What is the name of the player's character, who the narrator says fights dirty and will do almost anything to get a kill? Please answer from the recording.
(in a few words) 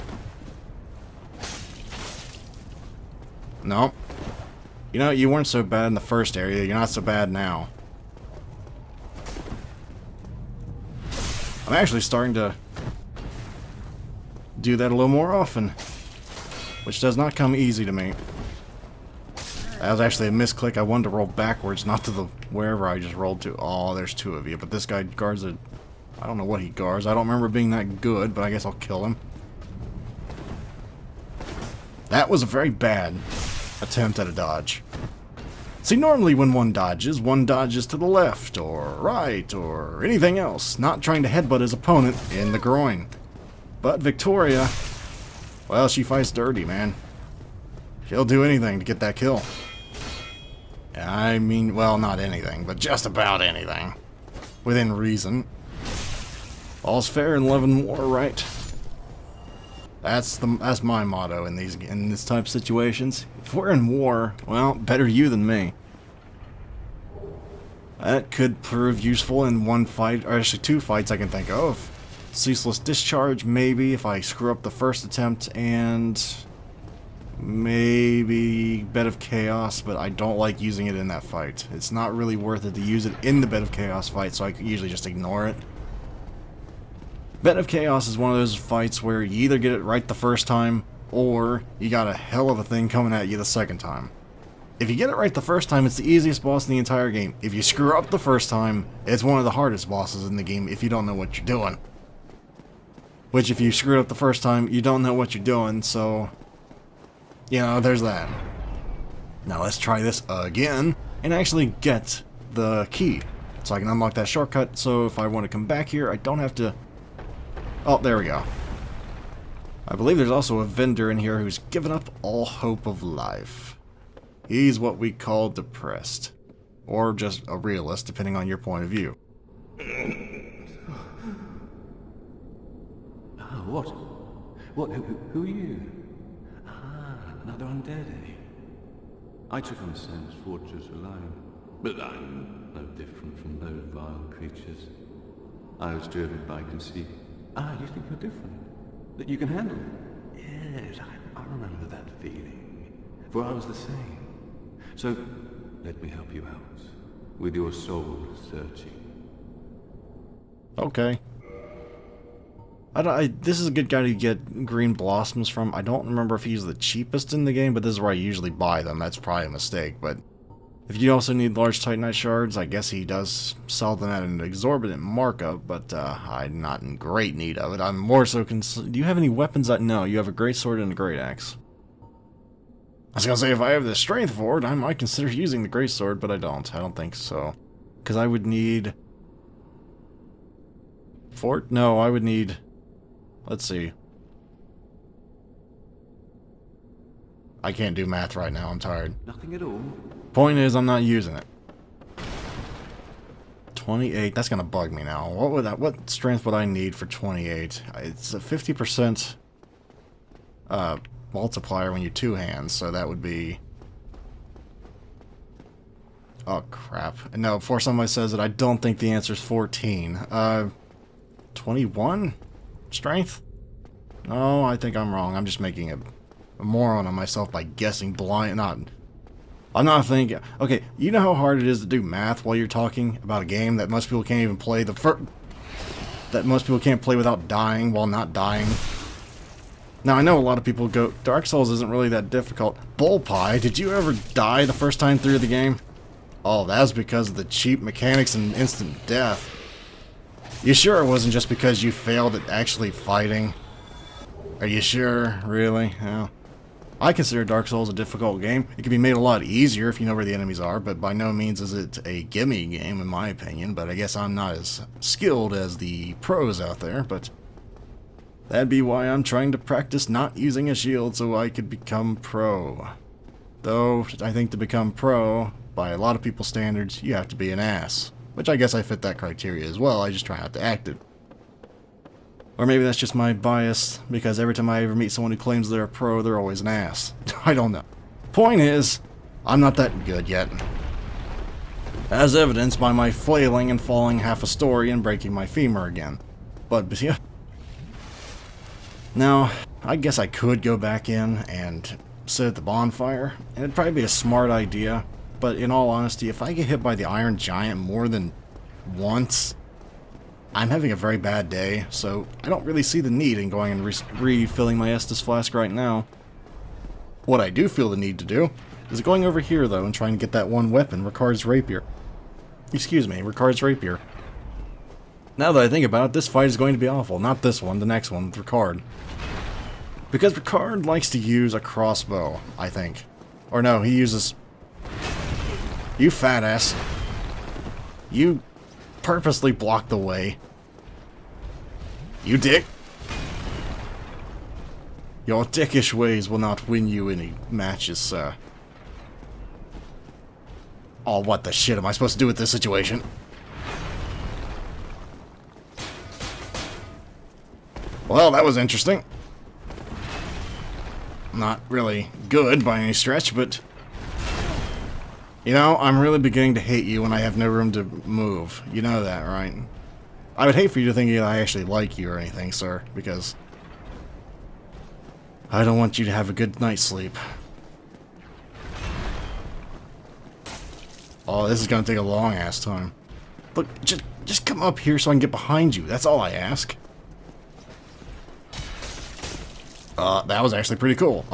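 Victoria.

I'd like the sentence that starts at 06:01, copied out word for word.
Not really good by any stretch, but...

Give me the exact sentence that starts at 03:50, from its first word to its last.
Okay, you know how hard it is to do math while you're talking about a game that most people can't even play.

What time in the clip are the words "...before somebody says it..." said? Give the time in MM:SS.
03:37.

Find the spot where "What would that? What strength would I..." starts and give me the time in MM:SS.
03:25.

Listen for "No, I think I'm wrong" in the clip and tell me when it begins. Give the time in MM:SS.
03:44.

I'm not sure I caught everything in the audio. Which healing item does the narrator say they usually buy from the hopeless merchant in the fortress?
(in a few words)
green blossoms.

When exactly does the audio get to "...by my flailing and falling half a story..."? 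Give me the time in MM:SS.
04:52.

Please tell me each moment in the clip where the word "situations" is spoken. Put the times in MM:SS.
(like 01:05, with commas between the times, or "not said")
01:02, 05:52.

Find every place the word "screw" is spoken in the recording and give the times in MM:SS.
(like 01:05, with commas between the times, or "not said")
01:14, 01:37, 01:43.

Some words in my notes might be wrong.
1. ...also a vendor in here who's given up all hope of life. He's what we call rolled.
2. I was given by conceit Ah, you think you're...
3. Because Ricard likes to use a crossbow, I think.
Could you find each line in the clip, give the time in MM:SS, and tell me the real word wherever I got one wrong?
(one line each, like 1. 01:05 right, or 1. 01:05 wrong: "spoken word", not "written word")
1. 02:00 wrong: "depressed", not "rolled"
2. 02:25 wrong: "driven", not "given"
3. 05:30 right.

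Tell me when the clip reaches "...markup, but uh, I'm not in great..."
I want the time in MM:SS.
02:55.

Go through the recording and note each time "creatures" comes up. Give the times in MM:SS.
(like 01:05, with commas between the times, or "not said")
02:24.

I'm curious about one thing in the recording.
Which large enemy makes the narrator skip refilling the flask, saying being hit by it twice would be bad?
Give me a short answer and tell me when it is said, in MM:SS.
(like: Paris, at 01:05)
Iron Giant, at 05:07.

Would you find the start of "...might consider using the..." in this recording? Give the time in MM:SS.
03:04.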